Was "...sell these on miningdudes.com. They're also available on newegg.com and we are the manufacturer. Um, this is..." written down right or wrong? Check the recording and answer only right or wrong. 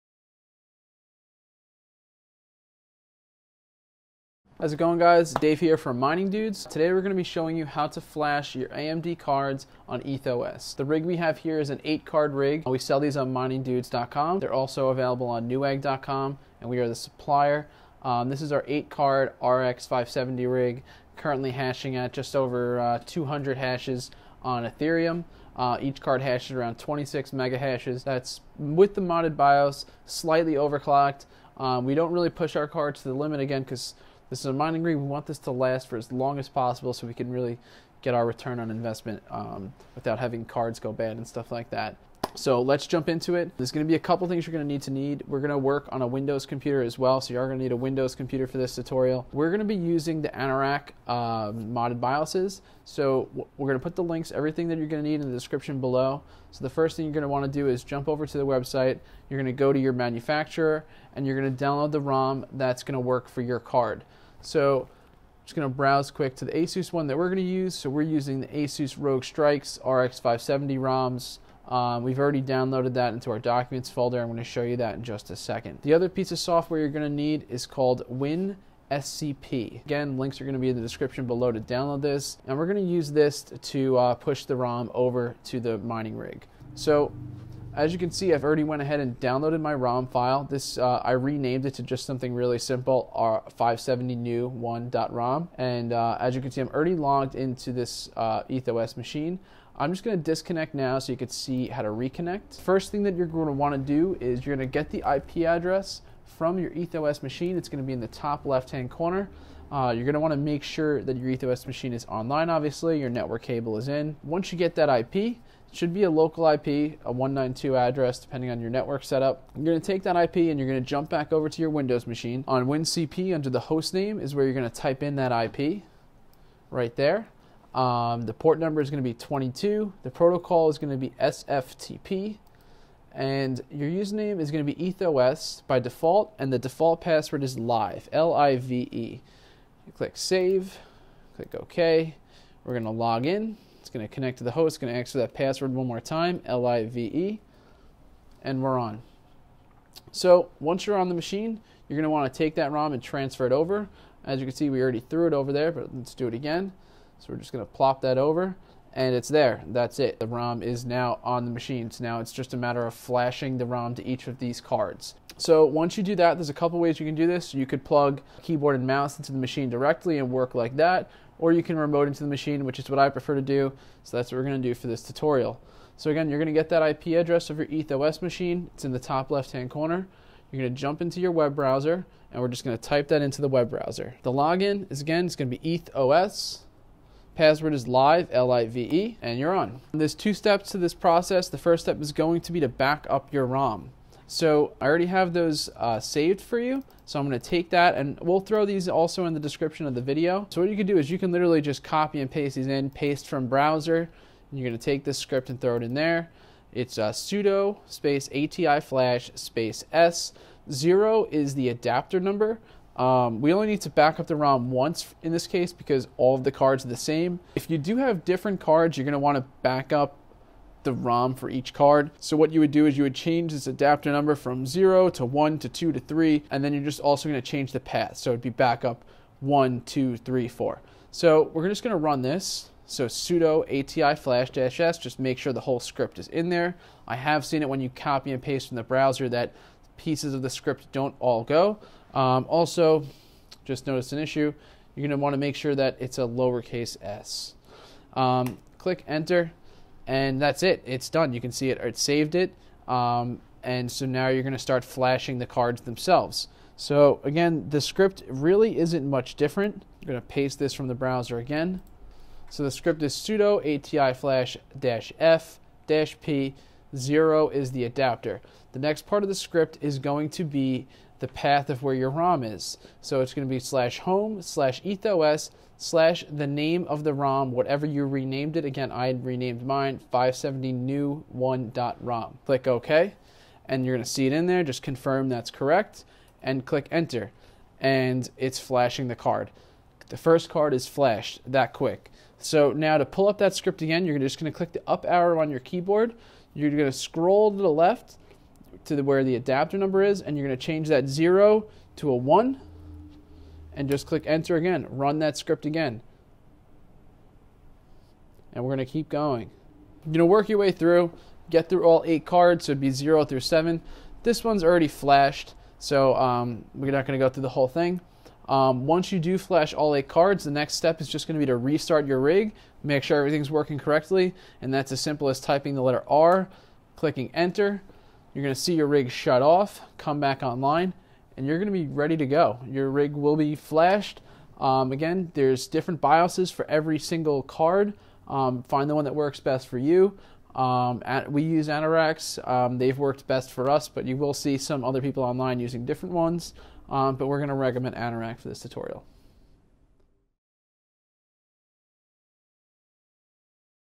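wrong.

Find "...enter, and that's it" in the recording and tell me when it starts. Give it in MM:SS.
04:09.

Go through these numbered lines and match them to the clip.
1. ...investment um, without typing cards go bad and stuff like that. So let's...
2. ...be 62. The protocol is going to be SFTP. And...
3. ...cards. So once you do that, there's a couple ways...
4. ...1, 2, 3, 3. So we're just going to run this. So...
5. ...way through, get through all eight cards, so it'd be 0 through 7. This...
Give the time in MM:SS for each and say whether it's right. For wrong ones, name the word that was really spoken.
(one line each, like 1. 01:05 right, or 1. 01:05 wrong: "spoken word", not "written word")
1. 00:38 wrong: "having", not "typing"
2. 02:09 wrong: "22", not "62"
3. 02:44 right
4. 03:49 wrong: "4", not "3"
5. 05:10 right.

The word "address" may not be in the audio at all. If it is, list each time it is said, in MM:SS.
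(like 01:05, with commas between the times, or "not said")
01:45, 01:57, 02:57.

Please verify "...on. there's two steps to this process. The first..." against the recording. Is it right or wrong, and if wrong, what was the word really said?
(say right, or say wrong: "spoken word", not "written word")
right.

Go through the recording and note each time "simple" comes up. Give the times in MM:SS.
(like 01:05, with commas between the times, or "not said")
01:32, 05:24.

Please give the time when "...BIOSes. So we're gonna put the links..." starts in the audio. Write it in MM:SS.
00:51.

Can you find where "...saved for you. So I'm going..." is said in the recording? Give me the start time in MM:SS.
03:16.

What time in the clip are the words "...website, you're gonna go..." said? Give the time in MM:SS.
00:58.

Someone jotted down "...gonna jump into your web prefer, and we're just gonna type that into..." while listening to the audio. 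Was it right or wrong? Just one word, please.
wrong.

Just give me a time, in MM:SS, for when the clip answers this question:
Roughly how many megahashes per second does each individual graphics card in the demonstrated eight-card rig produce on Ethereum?
00:26.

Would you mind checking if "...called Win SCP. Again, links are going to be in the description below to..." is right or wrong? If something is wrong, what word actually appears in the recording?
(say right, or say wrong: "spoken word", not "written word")
right.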